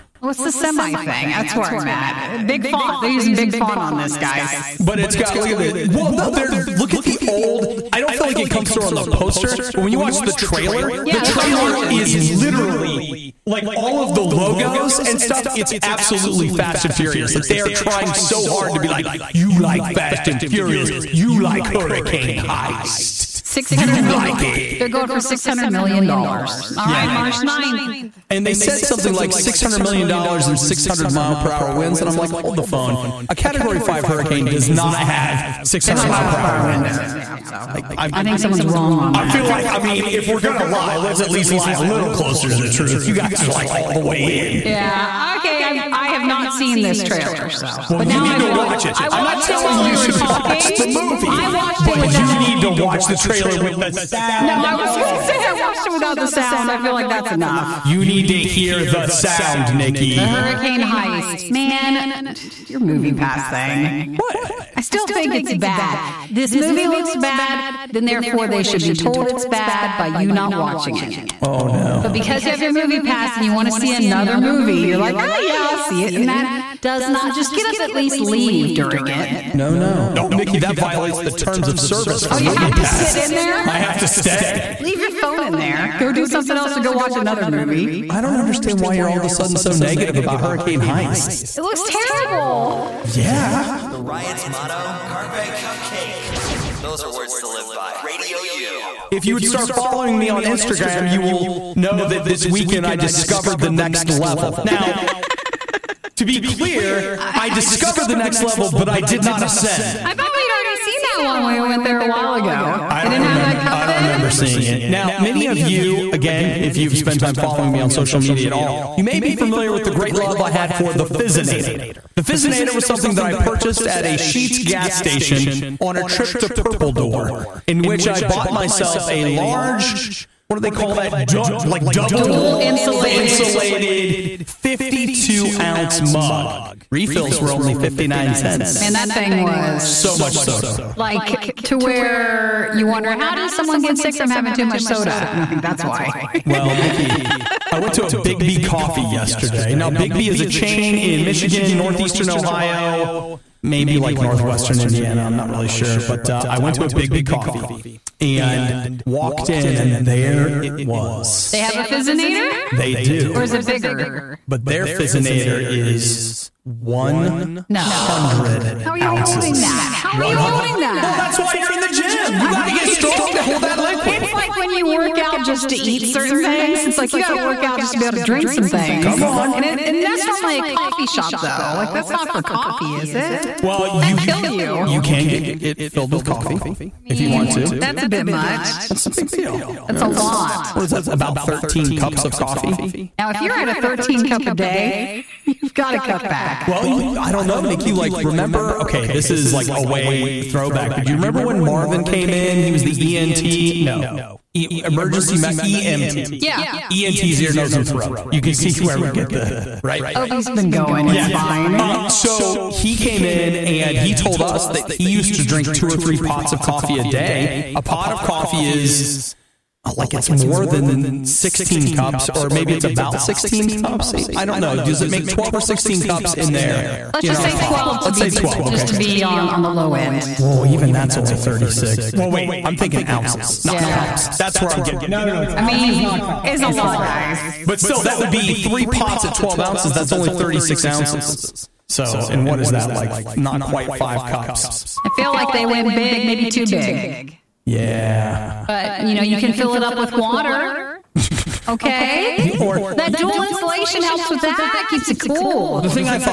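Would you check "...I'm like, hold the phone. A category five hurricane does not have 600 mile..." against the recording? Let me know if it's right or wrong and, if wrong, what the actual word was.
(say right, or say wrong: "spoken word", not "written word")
right.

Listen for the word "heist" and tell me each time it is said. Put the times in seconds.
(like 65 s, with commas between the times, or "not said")
22 s, 60 s, 90 s.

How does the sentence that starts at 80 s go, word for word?
No, Nikki, that violates the terms of service for oh, you movie have to pass.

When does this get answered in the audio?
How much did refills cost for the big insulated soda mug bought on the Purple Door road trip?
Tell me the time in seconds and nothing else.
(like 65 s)
137 s.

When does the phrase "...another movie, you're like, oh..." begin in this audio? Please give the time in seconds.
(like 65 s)
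73 s.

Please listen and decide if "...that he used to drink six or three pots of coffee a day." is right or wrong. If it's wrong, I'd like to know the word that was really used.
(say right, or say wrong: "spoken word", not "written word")
wrong: "two", not "six".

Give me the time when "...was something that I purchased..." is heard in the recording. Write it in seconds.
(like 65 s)
122 s.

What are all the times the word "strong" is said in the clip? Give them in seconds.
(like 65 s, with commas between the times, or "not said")
172 s.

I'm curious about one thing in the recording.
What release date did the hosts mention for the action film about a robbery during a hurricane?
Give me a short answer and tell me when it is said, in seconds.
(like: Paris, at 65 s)
March 9th, at 27 s.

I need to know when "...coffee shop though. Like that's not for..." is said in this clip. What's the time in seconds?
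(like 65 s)
180 s.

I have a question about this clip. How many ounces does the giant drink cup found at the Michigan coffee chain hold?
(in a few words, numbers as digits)
100 ounces.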